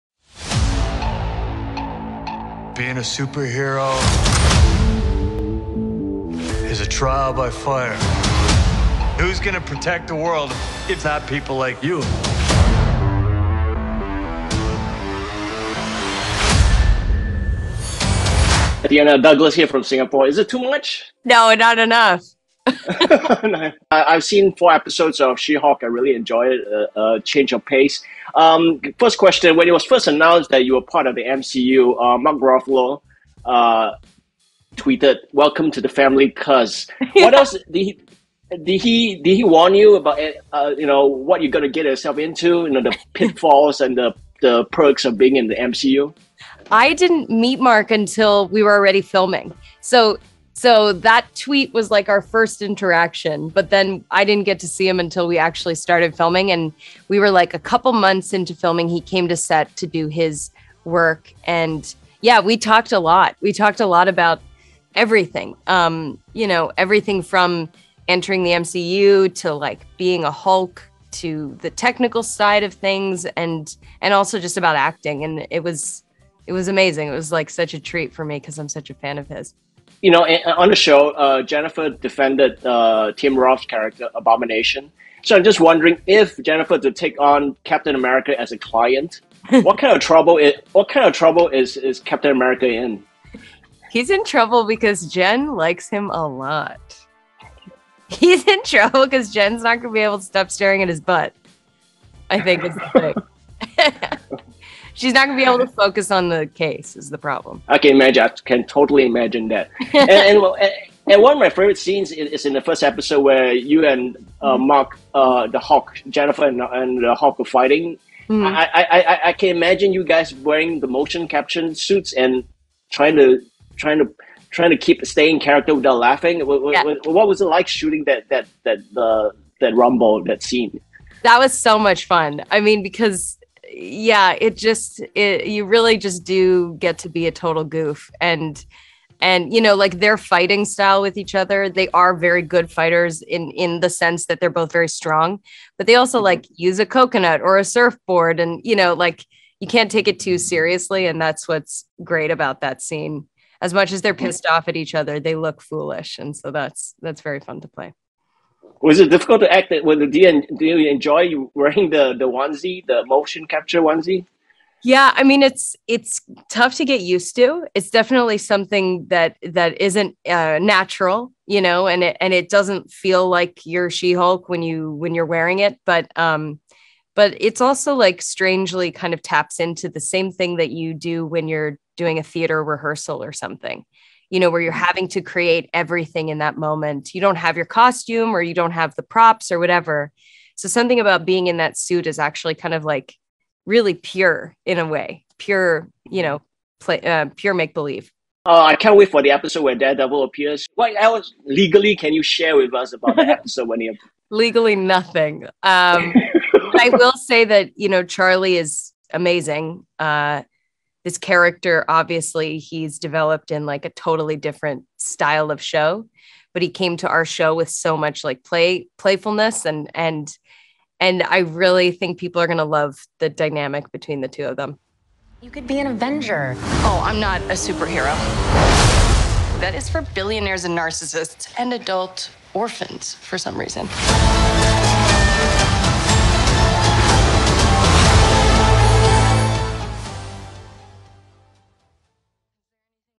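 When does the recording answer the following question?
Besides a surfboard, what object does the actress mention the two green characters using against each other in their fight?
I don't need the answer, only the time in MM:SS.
02:26.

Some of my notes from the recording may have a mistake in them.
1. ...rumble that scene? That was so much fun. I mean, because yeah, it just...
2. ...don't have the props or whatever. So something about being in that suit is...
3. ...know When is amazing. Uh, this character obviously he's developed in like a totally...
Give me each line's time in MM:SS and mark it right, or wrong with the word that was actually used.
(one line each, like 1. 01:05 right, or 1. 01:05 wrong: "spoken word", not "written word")
1. 02:09 right
2. 03:08 right
3. 03:27 wrong: "Charlie", not "When".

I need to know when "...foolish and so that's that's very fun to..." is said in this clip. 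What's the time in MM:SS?
02:35.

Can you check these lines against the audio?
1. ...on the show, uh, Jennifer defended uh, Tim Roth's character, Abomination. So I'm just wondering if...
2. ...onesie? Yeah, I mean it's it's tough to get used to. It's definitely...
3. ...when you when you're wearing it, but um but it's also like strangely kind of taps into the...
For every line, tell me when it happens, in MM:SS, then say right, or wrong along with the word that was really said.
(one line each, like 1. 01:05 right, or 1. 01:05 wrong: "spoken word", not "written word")
1. 01:20 right
2. 02:43 right
3. 02:54 right.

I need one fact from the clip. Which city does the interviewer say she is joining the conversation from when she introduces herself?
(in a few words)
Singapore.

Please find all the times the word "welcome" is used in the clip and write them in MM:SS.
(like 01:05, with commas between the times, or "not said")
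00:35.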